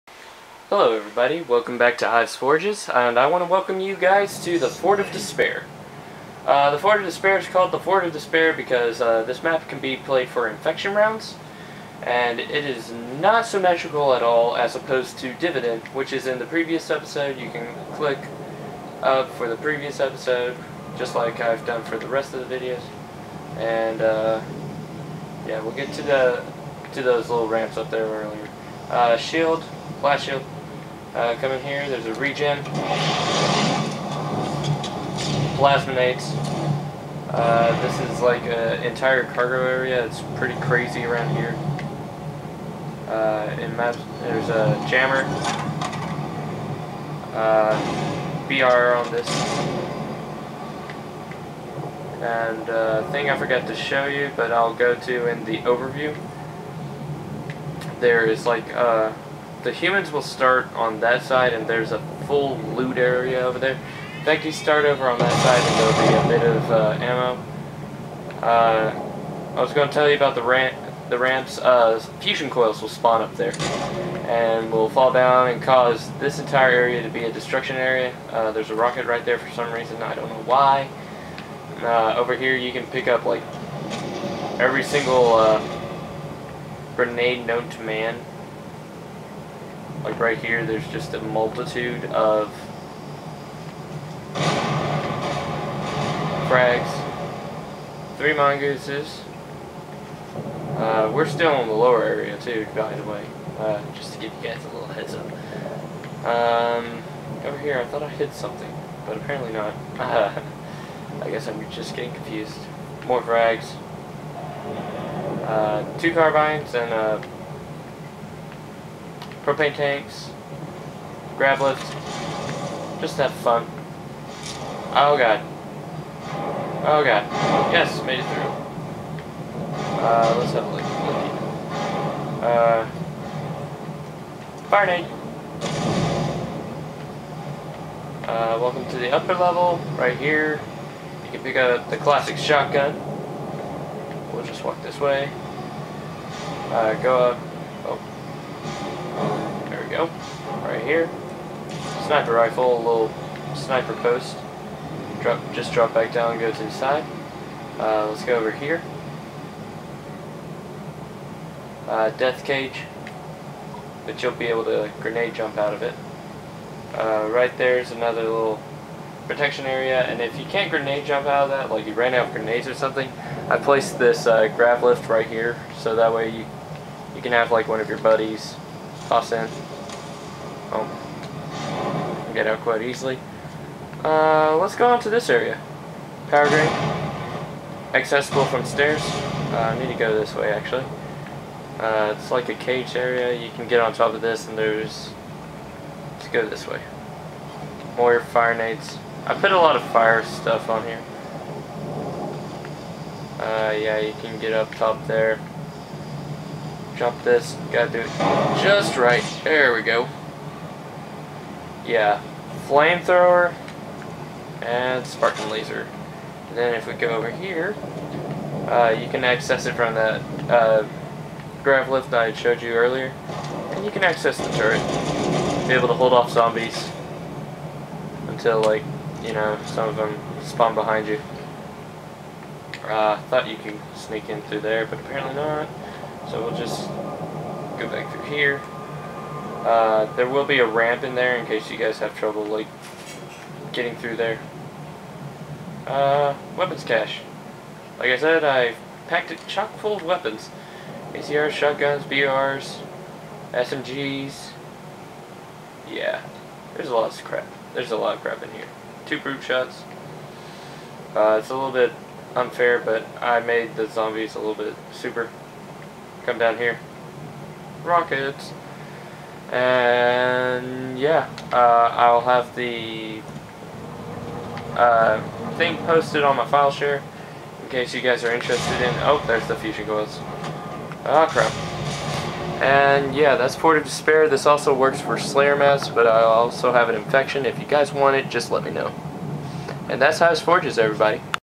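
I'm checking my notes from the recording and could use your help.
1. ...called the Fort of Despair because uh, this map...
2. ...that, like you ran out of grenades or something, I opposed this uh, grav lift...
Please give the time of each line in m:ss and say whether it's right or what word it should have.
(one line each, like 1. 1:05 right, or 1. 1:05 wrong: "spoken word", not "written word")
1. 0:07 right
2. 2:51 wrong: "placed", not "opposed".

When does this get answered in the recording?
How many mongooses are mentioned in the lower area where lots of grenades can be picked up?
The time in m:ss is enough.
1:38.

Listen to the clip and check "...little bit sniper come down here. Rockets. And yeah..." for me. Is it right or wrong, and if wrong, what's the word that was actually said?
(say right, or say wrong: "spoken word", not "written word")
wrong: "super", not "sniper".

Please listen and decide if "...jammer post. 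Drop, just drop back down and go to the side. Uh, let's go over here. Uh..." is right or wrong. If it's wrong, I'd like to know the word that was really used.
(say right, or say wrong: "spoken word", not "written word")
wrong: "sniper", not "jammer".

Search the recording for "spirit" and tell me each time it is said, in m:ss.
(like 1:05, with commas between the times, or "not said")
not said.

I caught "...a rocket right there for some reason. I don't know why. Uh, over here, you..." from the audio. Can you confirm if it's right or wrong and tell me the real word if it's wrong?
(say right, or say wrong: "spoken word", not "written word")
right.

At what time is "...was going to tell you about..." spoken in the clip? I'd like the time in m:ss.
1:09.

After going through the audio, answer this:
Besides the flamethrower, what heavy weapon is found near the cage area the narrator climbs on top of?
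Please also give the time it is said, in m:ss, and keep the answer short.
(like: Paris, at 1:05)
Spartan Laser, at 3:35.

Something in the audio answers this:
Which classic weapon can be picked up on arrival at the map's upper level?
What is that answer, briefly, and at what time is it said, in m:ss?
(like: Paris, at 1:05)
Shotgun, at 2:21.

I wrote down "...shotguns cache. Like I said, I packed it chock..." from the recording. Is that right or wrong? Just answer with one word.
wrong.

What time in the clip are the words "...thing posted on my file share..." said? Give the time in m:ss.
4:35.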